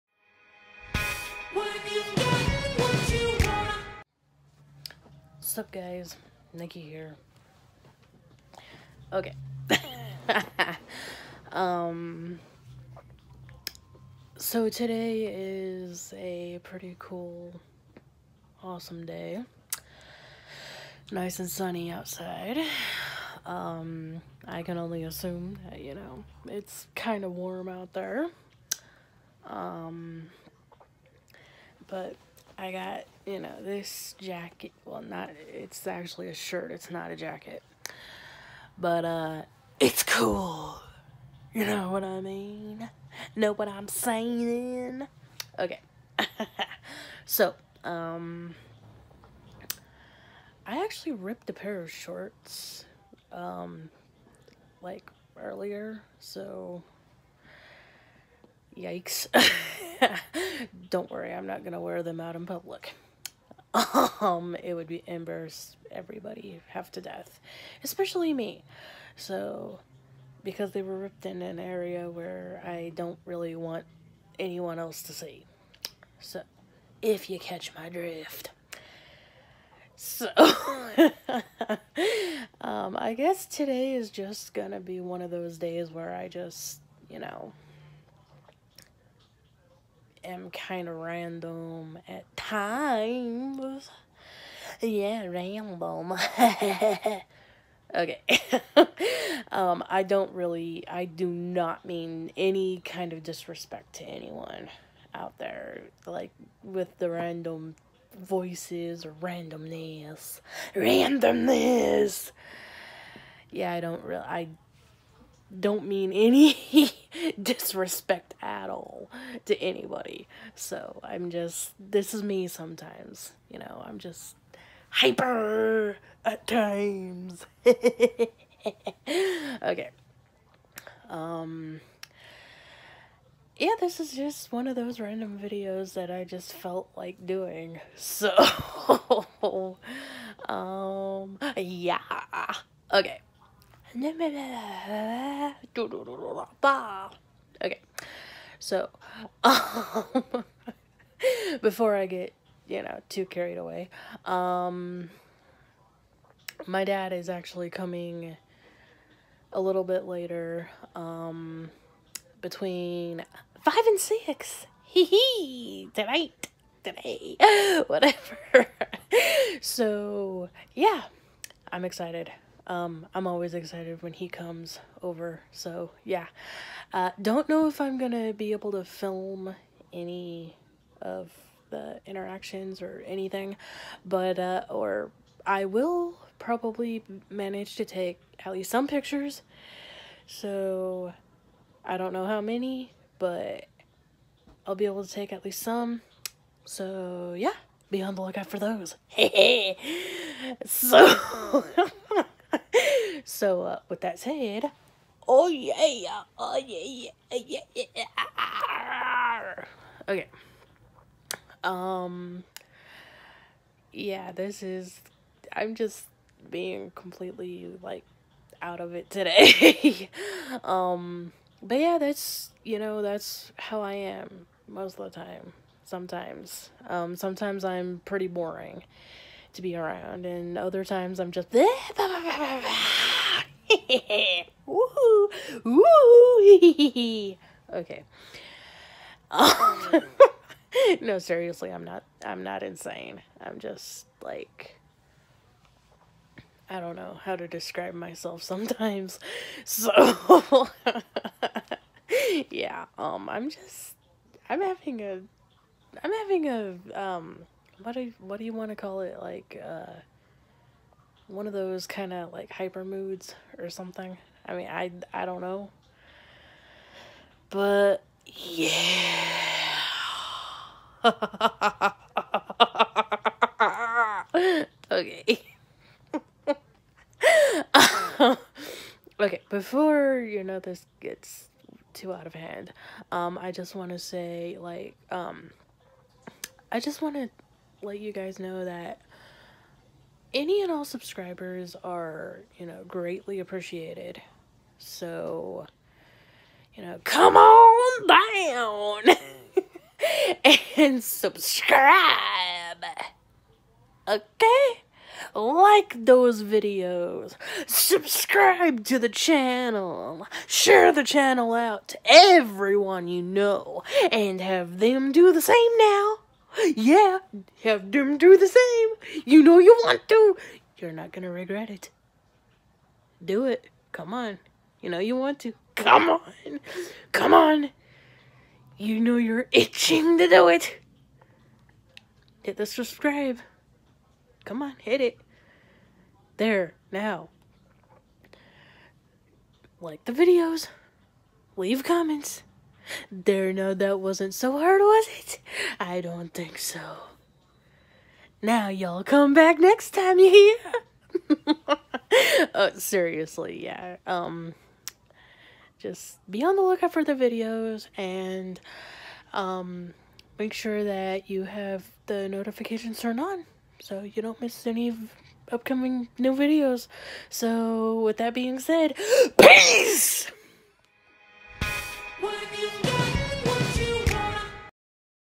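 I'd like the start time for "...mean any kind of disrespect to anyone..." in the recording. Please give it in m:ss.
1:41.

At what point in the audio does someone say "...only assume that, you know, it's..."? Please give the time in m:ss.
0:24.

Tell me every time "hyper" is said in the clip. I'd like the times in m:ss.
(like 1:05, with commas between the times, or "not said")
2:04, 4:22.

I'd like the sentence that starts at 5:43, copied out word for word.
There, no, that wasn't so hard, was it?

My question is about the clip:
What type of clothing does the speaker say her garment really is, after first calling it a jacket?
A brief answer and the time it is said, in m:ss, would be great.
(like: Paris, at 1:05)
shirt, at 0:36.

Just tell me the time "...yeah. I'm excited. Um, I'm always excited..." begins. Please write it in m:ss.
2:50.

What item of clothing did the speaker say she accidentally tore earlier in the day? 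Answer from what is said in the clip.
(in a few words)
pair of shorts.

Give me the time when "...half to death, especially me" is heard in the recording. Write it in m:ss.
1:06.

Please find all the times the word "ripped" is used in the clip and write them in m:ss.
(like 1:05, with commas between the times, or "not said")
0:51, 1:10.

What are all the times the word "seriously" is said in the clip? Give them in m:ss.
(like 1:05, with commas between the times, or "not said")
4:01, 5:52.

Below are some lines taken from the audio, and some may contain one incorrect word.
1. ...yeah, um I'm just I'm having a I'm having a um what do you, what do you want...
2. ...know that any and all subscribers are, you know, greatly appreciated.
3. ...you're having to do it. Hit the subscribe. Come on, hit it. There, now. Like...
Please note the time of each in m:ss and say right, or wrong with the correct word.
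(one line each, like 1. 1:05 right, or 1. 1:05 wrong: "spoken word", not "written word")
1. 4:12 right
2. 4:48 right
3. 5:29 wrong: "itching", not "having".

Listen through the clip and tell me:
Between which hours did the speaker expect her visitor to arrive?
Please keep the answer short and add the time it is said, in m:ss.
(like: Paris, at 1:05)
between 5 and 6, at 2:42.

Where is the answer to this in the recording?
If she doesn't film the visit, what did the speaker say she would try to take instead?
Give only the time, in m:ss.
3:08.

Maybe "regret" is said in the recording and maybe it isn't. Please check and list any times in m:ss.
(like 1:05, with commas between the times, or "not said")
5:21.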